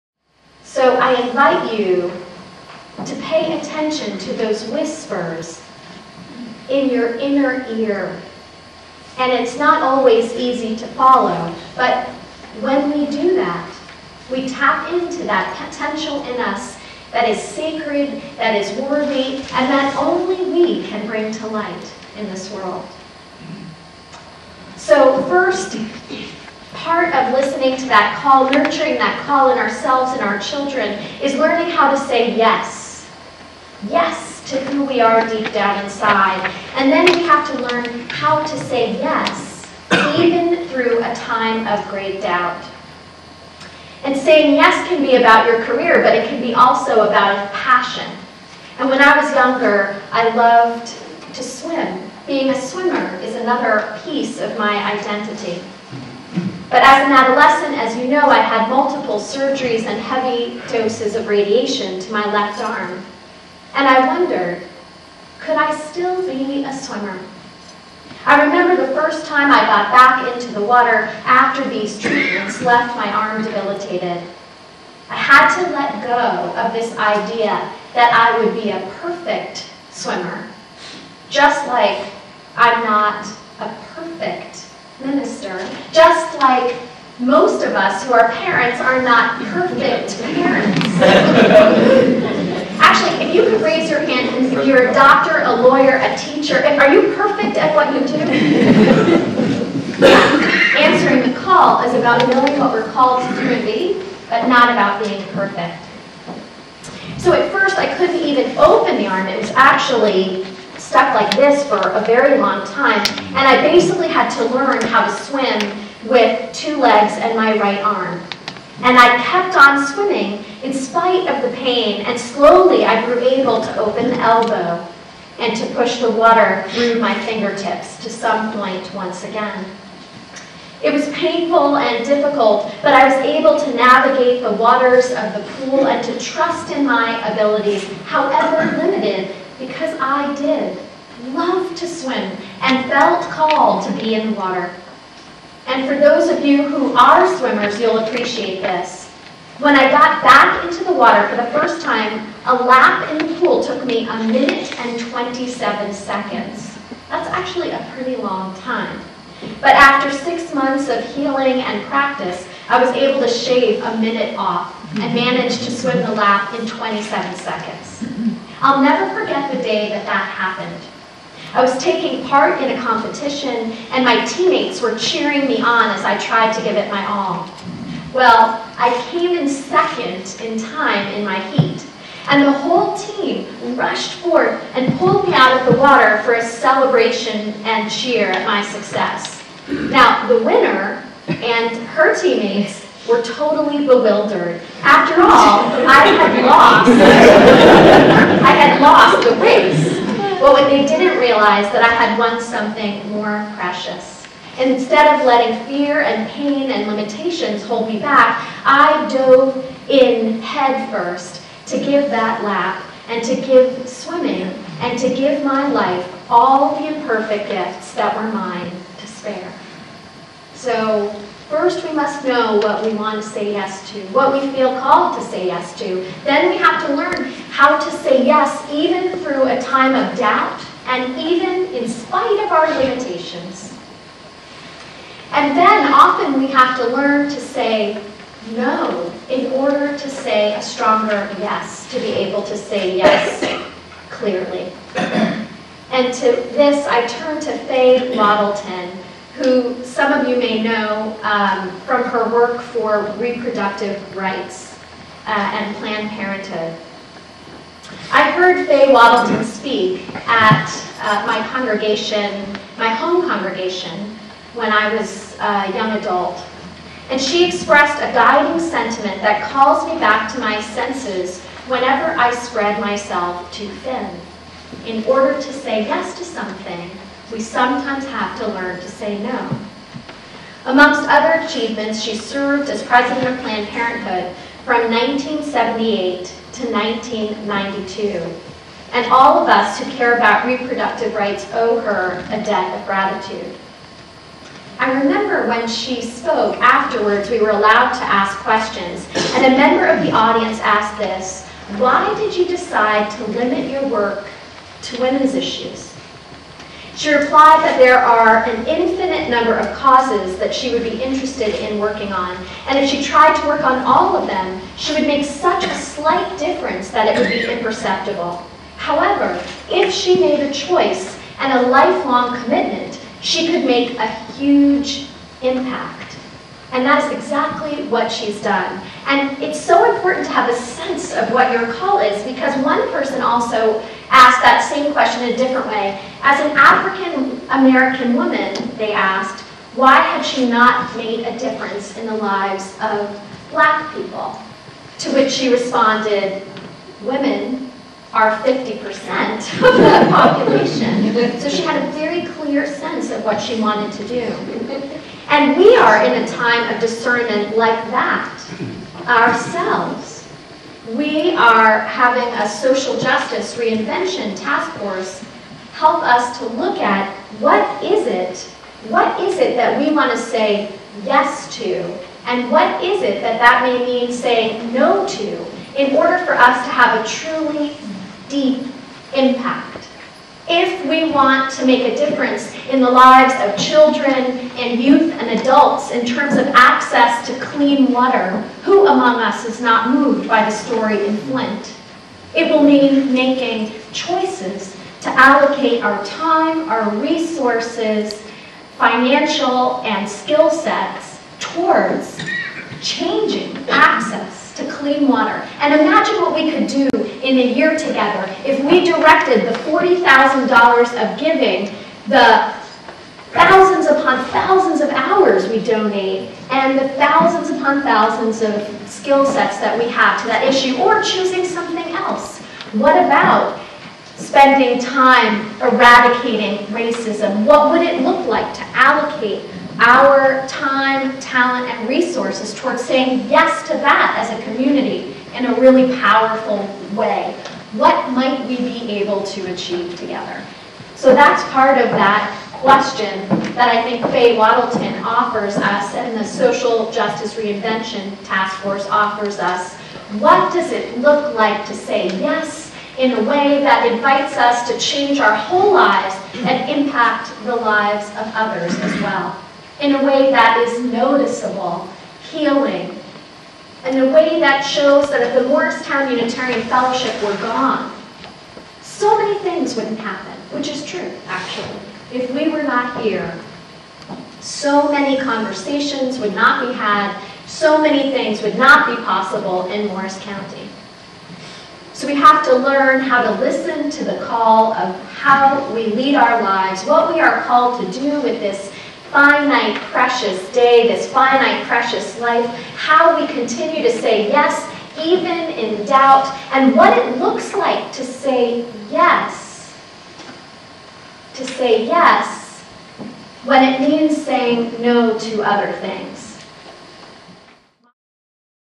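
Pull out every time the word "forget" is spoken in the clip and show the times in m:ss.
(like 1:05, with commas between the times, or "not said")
2:49.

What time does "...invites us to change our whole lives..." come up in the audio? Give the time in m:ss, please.
7:33.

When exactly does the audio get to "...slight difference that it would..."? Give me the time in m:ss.
5:15.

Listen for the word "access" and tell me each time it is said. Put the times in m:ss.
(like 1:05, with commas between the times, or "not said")
6:26, 6:43.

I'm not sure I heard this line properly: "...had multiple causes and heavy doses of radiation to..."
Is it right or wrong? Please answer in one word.
wrong.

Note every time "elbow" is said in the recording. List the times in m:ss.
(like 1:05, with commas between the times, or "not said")
2:04.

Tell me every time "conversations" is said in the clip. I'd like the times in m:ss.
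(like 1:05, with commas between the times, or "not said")
7:55.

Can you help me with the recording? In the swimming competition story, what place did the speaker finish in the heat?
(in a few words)
second.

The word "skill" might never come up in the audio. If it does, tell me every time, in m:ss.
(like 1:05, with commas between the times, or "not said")
6:40, 6:58.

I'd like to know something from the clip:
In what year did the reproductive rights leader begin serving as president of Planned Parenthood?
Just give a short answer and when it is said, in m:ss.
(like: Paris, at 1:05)
1978, at 4:44.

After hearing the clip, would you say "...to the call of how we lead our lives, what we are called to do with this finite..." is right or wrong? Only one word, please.
right.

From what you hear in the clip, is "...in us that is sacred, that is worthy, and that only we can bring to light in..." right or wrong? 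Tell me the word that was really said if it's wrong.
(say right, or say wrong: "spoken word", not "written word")
right.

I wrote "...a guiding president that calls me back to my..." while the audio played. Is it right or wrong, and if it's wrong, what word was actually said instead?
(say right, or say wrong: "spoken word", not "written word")
wrong: "sentiment", not "president".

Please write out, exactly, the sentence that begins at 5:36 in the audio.
As an African American woman, they asked, why had she not made a difference in the lives of black people?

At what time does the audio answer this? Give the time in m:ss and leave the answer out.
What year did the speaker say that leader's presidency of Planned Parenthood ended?
4:46.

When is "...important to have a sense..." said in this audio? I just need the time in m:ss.
5:29.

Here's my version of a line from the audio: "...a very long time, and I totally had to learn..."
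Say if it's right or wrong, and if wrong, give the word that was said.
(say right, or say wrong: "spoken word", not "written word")
wrong: "basically", not "totally".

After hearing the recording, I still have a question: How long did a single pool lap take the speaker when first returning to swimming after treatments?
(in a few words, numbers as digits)
1 minute 27 seconds.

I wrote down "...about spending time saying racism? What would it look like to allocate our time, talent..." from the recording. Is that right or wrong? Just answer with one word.
wrong.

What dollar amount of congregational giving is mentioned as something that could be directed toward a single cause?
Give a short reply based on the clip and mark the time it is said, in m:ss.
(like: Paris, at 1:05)
$40,000, at 6:49.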